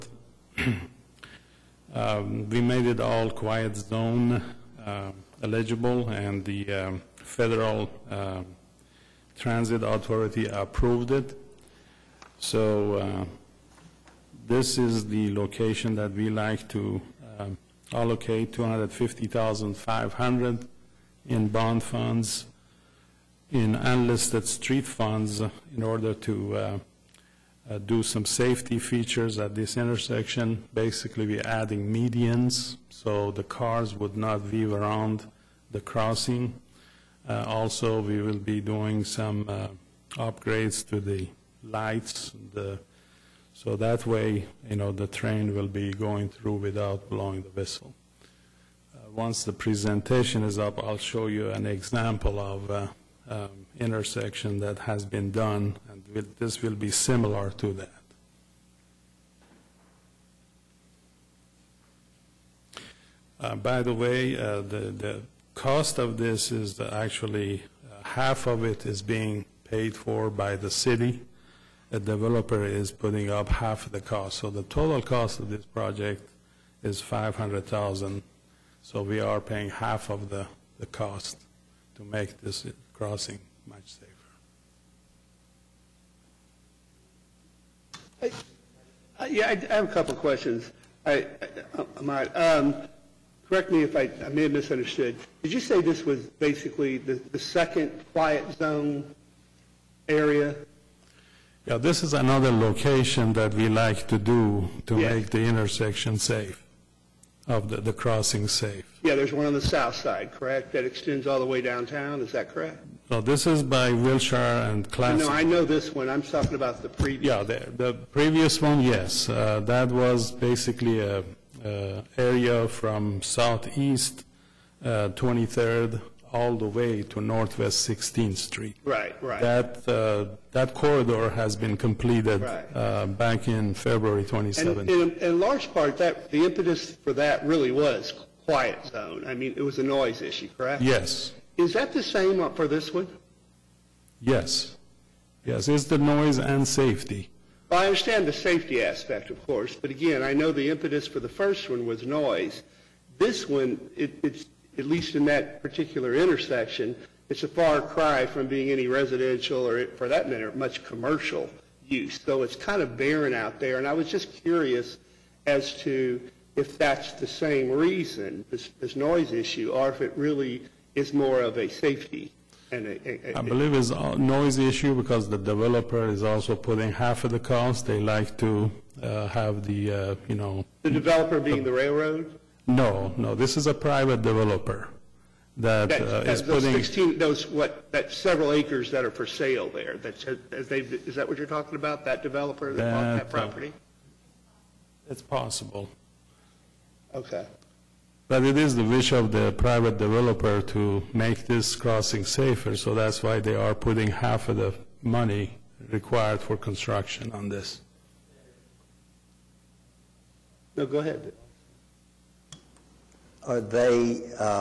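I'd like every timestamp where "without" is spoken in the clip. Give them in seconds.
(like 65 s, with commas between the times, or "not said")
46 s.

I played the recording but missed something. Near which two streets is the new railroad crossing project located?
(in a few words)
Wilshire and Classen.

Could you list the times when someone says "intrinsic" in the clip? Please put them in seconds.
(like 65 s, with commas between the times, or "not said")
not said.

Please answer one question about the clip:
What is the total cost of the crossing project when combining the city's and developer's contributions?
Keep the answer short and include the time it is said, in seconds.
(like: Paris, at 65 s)
500000, at 77 s.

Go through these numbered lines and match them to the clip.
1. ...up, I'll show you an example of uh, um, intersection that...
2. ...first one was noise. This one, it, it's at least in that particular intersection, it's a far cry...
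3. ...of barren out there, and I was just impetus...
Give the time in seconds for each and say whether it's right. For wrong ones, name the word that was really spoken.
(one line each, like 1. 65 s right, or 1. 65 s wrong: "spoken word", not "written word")
1. 50 s right
2. 151 s right
3. 162 s wrong: "curious", not "impetus".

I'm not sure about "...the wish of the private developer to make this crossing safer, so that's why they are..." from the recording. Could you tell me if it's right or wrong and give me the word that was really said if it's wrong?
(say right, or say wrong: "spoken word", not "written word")
right.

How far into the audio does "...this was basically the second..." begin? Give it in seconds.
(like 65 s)
95 s.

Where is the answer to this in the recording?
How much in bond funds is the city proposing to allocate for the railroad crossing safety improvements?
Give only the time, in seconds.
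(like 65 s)
18 s.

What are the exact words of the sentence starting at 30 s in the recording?
Basically, we're adding medians so the cars would not weave around the crossing.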